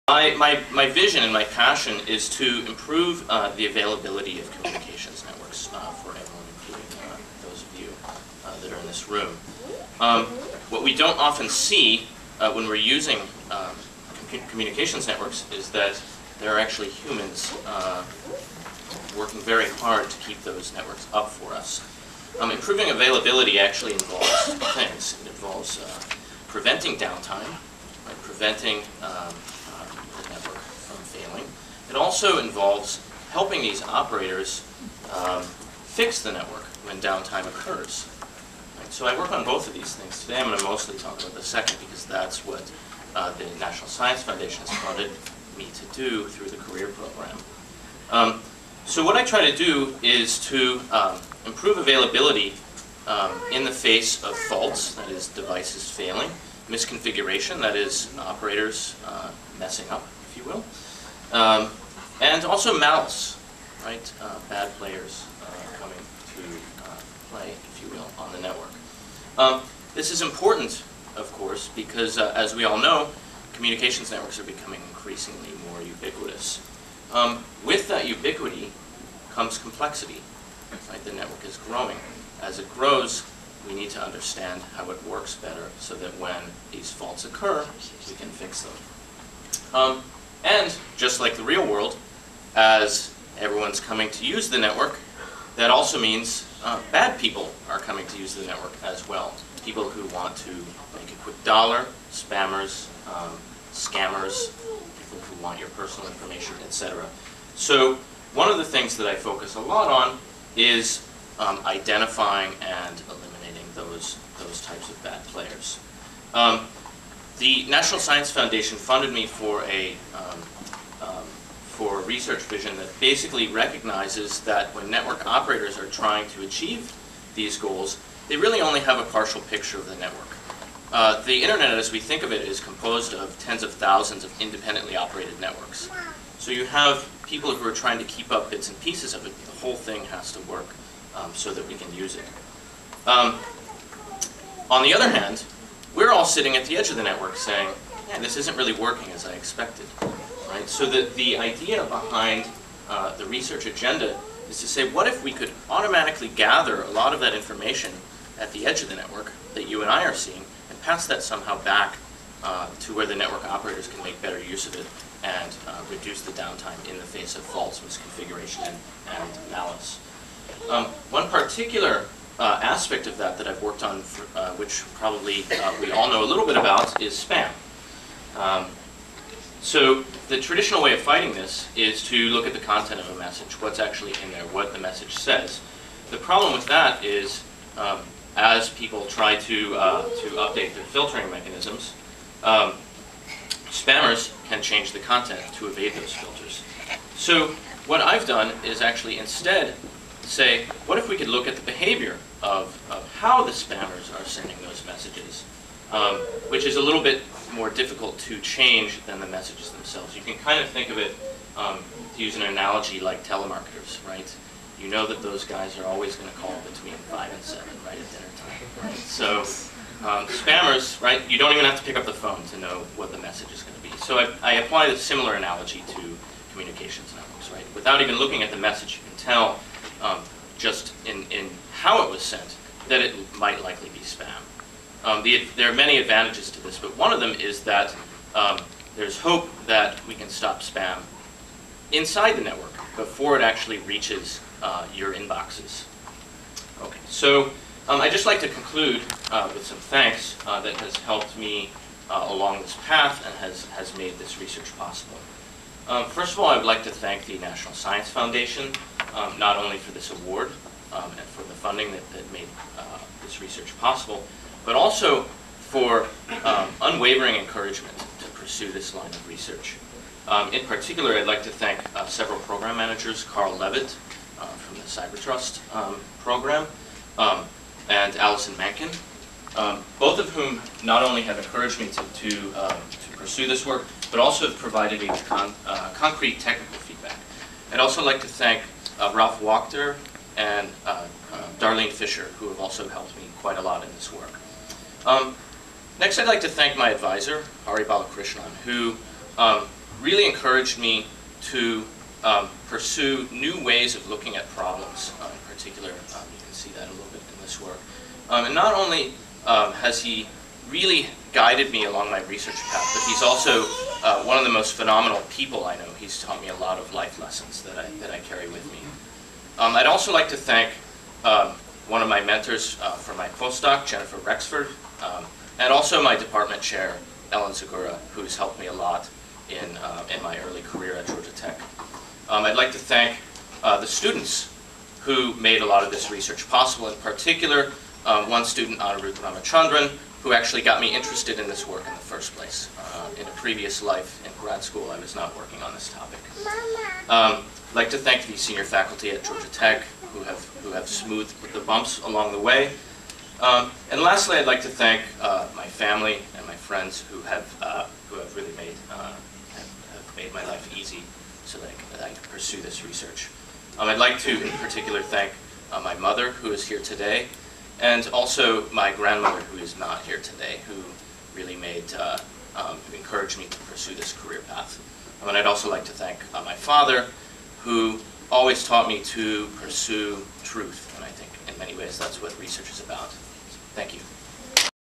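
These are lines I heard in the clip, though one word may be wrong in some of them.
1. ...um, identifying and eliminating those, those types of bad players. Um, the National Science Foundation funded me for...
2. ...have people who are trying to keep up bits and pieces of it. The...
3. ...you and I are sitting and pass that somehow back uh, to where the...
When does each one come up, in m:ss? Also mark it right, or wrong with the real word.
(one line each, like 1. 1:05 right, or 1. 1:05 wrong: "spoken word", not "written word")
1. 1:51 right
2. 2:16 right
3. 2:39 wrong: "seeing", not "sitting".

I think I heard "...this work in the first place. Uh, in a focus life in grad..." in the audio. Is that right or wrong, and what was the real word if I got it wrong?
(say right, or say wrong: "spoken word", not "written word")
wrong: "previous", not "focus".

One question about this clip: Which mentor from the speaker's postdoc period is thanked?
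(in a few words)
Jennifer Rexford.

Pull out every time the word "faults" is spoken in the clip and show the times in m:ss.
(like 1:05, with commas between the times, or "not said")
0:54, 1:26, 2:47.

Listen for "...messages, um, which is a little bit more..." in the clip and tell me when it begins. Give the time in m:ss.
3:24.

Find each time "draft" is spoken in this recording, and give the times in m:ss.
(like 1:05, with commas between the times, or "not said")
not said.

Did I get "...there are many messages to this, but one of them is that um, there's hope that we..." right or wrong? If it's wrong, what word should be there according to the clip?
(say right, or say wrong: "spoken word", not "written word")
wrong: "advantages", not "messages".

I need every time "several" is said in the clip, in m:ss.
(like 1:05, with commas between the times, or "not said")
4:32.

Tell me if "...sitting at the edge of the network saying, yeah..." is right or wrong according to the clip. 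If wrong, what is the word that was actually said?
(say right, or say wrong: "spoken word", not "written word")
right.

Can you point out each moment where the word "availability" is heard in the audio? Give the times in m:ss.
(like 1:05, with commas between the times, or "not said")
0:03, 0:22, 0:51.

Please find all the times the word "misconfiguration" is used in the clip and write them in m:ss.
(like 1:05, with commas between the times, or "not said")
0:56, 2:47.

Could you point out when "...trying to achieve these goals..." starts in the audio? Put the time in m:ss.
2:05.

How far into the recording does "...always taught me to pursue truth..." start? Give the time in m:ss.
6:18.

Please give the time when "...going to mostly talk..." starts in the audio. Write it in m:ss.
0:40.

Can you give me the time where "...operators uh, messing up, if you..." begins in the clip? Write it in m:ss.
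0:58.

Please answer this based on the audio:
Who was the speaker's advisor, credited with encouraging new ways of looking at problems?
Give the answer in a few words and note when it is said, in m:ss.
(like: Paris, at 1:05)
Hari Balakrishnan, at 4:57.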